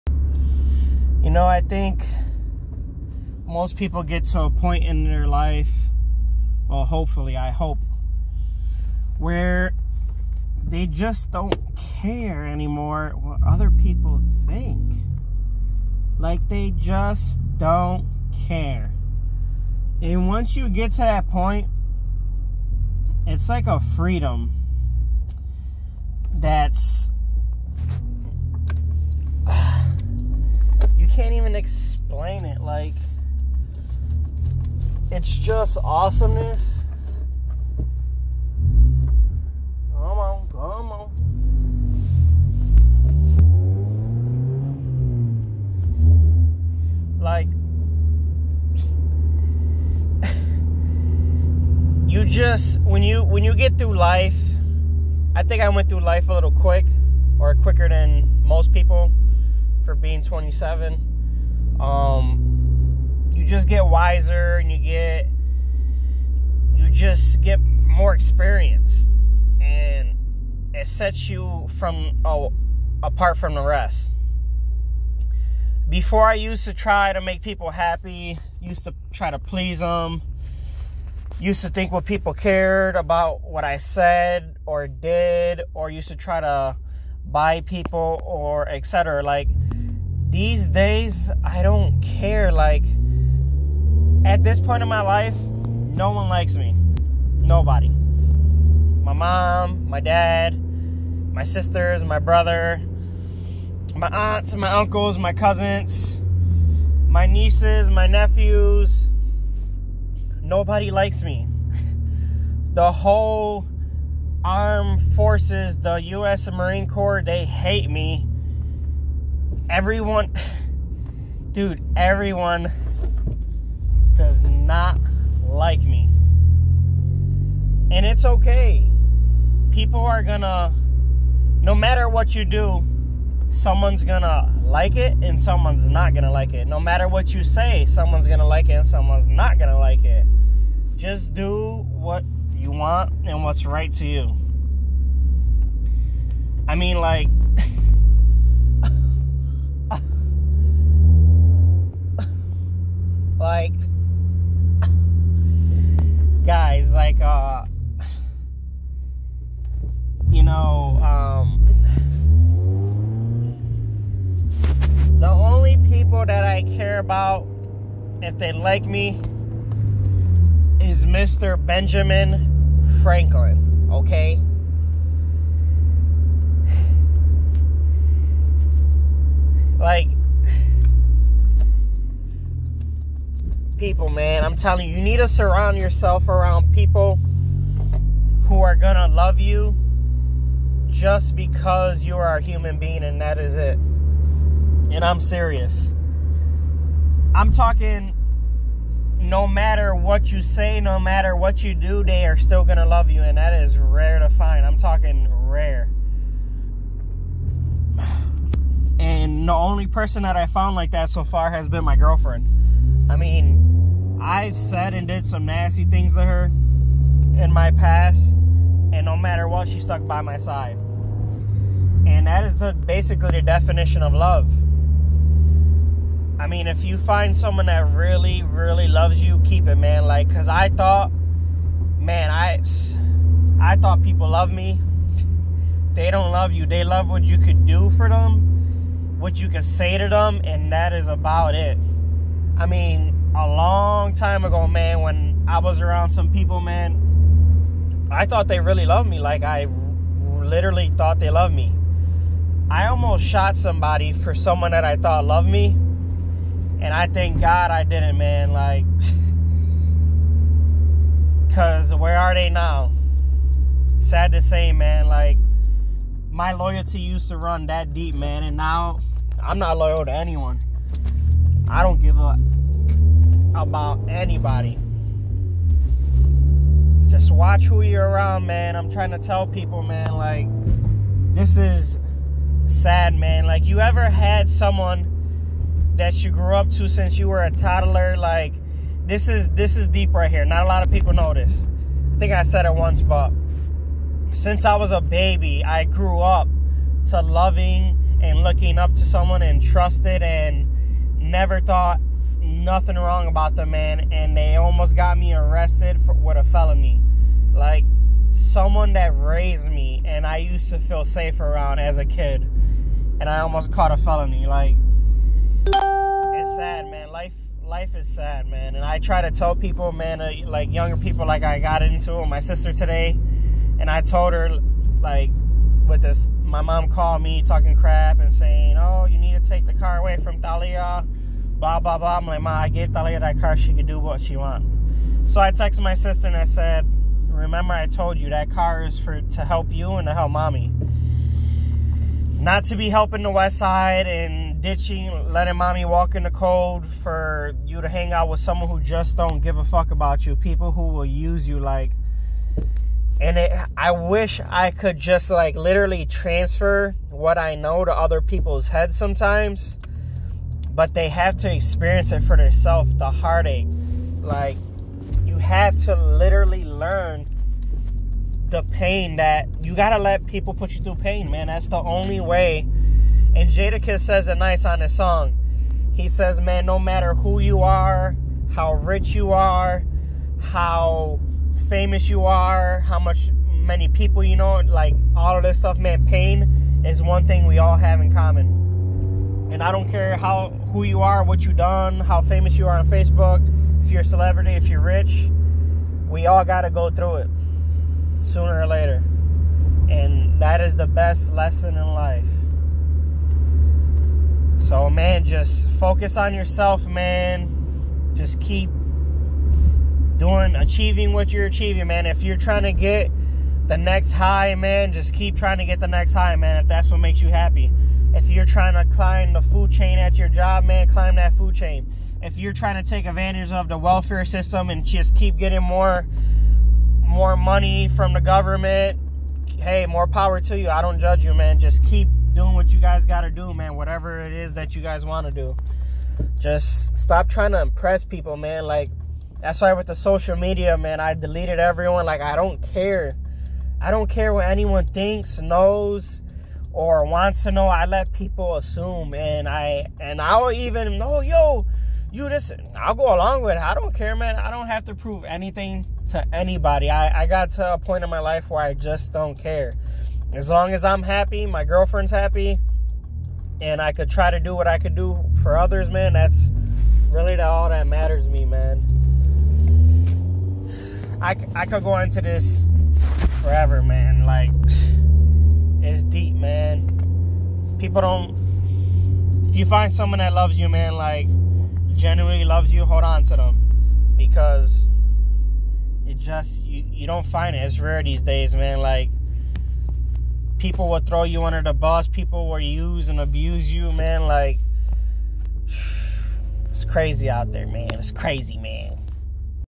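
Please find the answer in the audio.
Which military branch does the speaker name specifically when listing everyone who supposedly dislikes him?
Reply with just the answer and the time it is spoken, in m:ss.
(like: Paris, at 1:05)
U.S. Marine Corps, at 1:55.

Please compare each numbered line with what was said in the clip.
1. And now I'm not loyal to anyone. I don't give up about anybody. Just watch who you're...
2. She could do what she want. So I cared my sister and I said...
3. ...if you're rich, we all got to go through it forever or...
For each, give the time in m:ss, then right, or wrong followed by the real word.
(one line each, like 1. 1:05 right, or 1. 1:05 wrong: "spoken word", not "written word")
1. 4:28 right
2. 5:33 wrong: "texted", not "cared"
3. 6:34 wrong: "sooner", not "forever".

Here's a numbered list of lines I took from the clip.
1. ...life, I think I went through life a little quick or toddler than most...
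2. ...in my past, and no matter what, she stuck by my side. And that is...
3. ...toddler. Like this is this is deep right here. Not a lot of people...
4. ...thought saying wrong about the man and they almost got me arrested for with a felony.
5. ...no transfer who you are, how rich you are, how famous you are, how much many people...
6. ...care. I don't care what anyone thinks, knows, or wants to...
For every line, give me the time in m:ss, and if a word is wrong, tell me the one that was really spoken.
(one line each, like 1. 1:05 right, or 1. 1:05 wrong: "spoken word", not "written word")
1. 0:53 wrong: "quicker", not "toddler"
2. 3:37 right
3. 4:47 right
4. 5:01 wrong: "nothing", not "saying"
5. 6:16 wrong: "matter", not "transfer"
6. 7:22 right.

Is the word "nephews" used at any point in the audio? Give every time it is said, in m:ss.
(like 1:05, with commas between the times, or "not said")
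1:48.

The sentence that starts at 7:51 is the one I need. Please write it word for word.
I, I could go into this forever, man.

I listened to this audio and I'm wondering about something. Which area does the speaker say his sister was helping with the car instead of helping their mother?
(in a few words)
The West Side.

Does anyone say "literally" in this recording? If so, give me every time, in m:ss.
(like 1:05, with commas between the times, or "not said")
4:10, 5:55, 6:05.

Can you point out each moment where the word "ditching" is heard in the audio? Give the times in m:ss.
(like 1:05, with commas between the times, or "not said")
5:44.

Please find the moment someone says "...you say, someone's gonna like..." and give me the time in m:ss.
2:17.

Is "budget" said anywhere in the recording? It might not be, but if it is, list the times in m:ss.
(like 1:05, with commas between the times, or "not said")
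not said.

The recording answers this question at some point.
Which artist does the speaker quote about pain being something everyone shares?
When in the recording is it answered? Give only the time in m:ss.
6:13.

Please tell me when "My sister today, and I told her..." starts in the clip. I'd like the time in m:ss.
5:22.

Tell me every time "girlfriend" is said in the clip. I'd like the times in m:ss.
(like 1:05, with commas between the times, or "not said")
3:31, 7:41.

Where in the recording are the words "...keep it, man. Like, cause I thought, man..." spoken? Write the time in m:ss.
3:49.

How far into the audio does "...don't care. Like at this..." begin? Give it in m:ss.
1:31.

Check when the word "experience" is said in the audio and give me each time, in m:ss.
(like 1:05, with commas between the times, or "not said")
1:08, 6:01.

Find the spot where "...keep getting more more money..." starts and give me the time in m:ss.
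7:05.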